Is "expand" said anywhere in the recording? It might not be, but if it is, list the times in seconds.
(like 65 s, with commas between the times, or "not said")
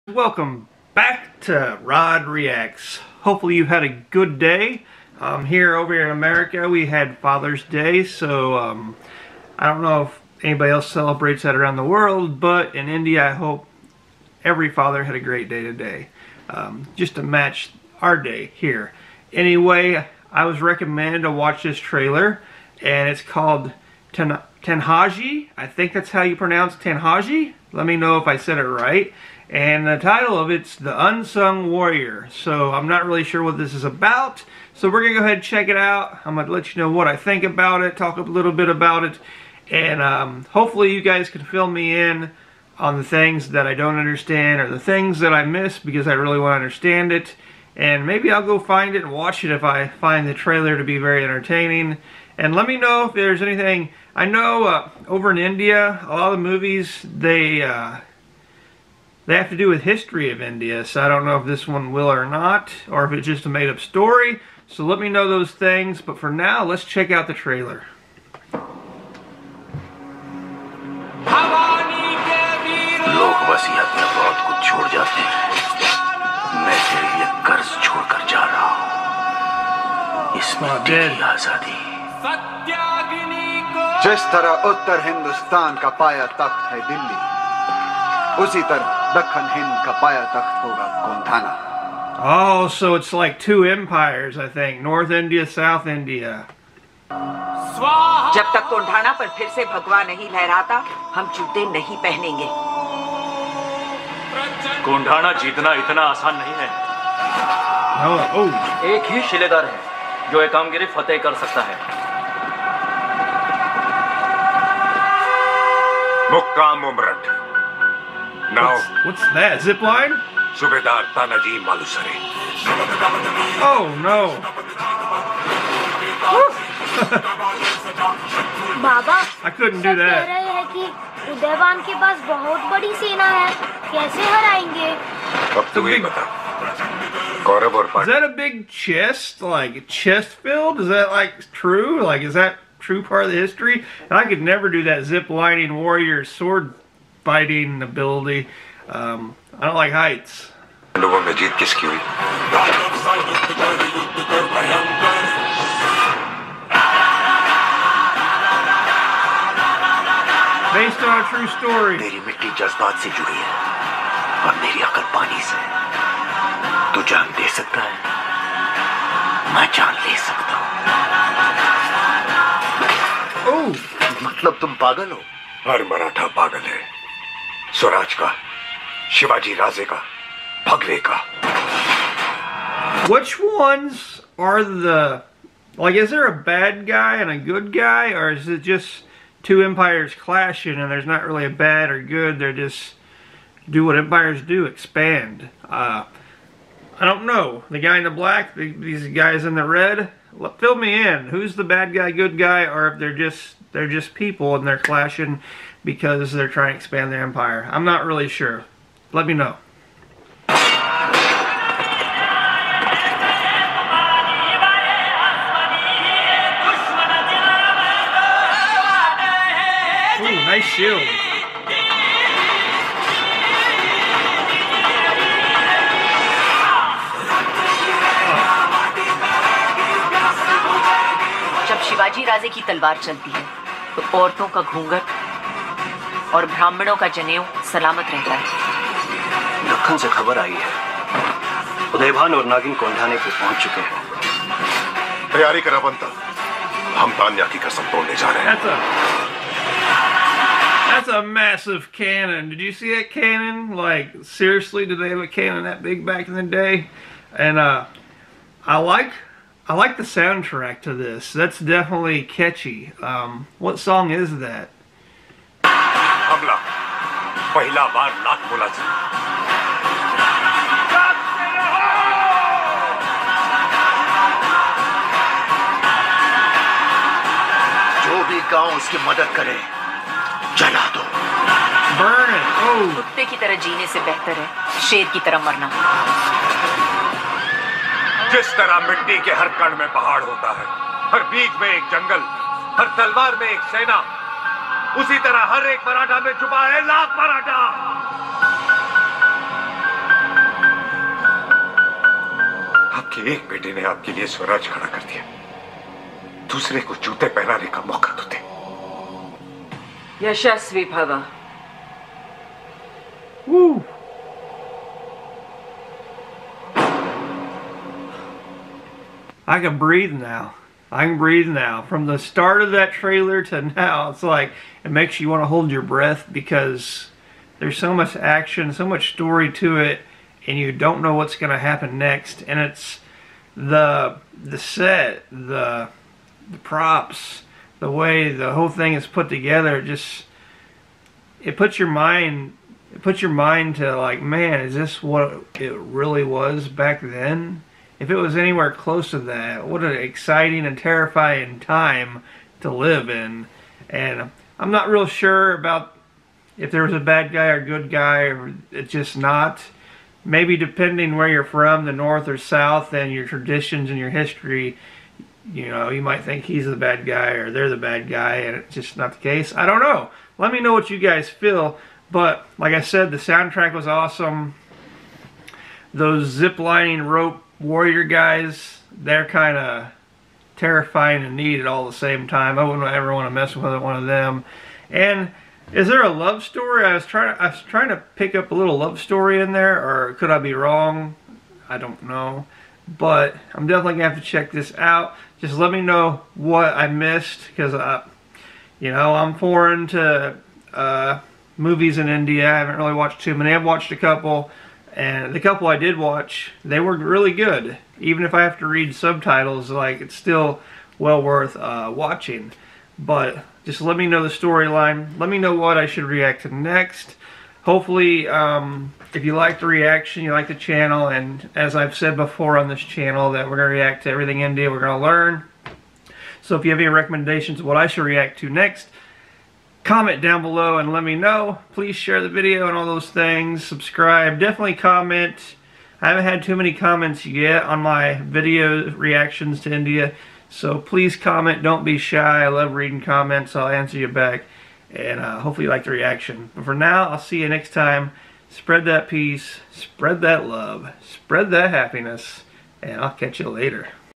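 194 s, 206 s.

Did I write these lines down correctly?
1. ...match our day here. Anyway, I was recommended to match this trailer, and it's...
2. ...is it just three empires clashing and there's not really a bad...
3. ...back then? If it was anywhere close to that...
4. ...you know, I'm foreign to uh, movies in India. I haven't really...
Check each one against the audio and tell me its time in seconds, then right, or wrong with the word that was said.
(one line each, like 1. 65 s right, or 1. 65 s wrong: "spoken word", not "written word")
1. 17 s wrong: "watch", not "match"
2. 188 s wrong: "two", not "three"
3. 346 s right
4. 398 s right.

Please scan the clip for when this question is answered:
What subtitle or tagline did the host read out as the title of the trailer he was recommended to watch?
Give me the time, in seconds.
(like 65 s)
30 s.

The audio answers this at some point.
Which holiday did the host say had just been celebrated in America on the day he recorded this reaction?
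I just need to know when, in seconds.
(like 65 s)
7 s.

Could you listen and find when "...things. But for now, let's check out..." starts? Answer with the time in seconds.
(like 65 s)
65 s.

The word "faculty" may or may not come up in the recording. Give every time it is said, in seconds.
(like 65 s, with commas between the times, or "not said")
not said.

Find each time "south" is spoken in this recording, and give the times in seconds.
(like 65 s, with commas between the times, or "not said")
95 s, 362 s.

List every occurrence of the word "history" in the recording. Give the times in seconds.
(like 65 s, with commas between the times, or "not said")
59 s, 143 s, 364 s.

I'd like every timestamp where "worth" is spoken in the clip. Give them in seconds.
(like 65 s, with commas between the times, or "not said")
411 s.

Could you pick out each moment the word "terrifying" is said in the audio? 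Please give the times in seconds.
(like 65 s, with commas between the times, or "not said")
350 s, 380 s.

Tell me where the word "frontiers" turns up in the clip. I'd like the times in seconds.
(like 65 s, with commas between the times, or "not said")
not said.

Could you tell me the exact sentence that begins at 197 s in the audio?
The guy in the black, the, these guys in the red.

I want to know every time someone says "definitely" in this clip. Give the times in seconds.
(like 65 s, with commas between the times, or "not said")
393 s, 434 s.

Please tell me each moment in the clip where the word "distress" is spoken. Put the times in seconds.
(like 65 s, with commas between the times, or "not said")
not said.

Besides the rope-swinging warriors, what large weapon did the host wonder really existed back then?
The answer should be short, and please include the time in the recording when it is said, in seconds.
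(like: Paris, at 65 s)
a massive cannon, at 251 s.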